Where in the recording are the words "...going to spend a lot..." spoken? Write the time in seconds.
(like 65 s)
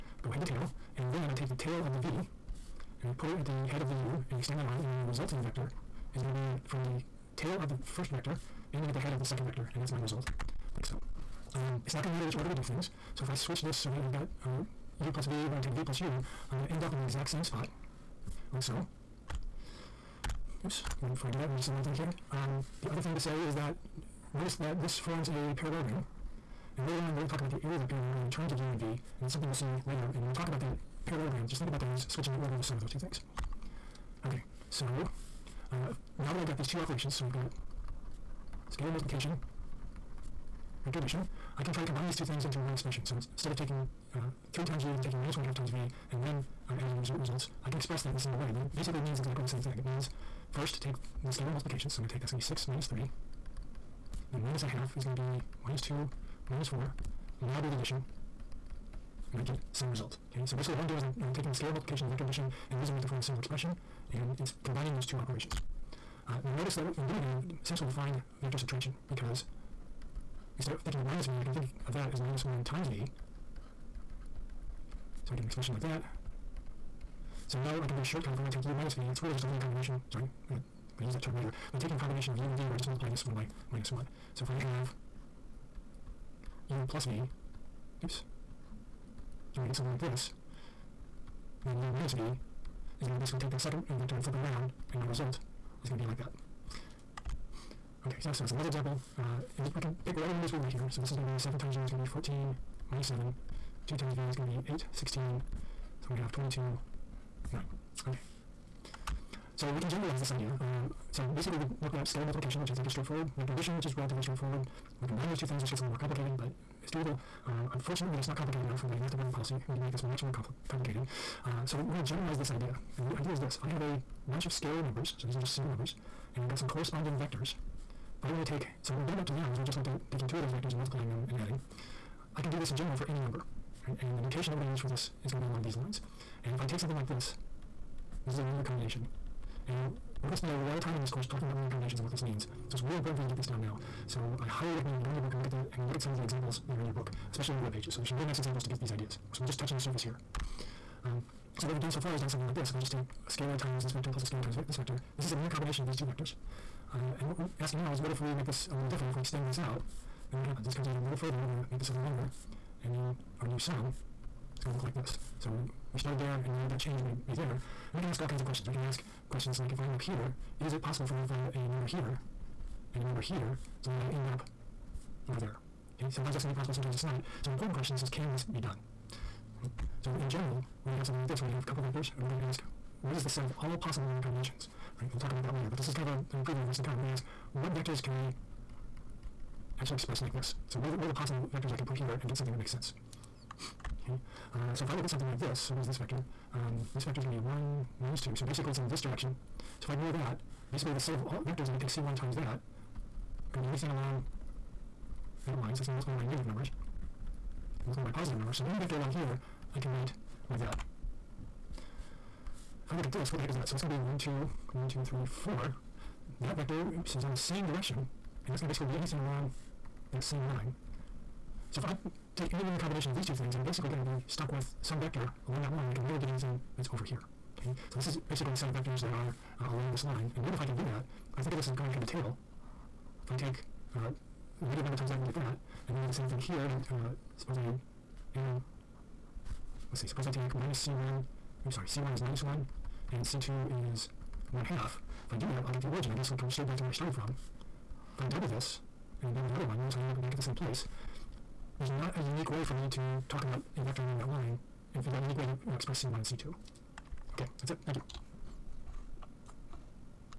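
140 s.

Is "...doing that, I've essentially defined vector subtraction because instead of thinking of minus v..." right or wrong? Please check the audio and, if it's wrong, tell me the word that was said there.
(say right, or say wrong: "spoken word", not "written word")
right.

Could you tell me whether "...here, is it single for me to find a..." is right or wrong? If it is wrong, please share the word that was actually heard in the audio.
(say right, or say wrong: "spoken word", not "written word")
wrong: "possible", not "single".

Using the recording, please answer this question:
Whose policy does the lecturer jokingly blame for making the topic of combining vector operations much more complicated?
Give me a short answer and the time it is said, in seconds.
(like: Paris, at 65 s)
math department, at 119 s.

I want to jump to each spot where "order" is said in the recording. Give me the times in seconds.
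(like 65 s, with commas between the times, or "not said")
12 s, 32 s.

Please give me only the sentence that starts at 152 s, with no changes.
If I just take a scalar times this vector plus a scalar times ve this vector.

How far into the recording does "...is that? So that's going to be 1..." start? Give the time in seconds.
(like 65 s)
213 s.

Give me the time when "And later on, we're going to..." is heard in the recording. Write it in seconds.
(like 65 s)
26 s.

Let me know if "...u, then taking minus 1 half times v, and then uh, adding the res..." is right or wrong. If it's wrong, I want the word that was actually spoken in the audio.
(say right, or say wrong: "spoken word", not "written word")
right.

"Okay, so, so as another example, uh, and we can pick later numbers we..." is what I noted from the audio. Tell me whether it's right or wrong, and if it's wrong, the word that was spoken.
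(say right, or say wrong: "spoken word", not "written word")
wrong: "whatever", not "later".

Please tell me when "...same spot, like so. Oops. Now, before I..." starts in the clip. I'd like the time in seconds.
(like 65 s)
17 s.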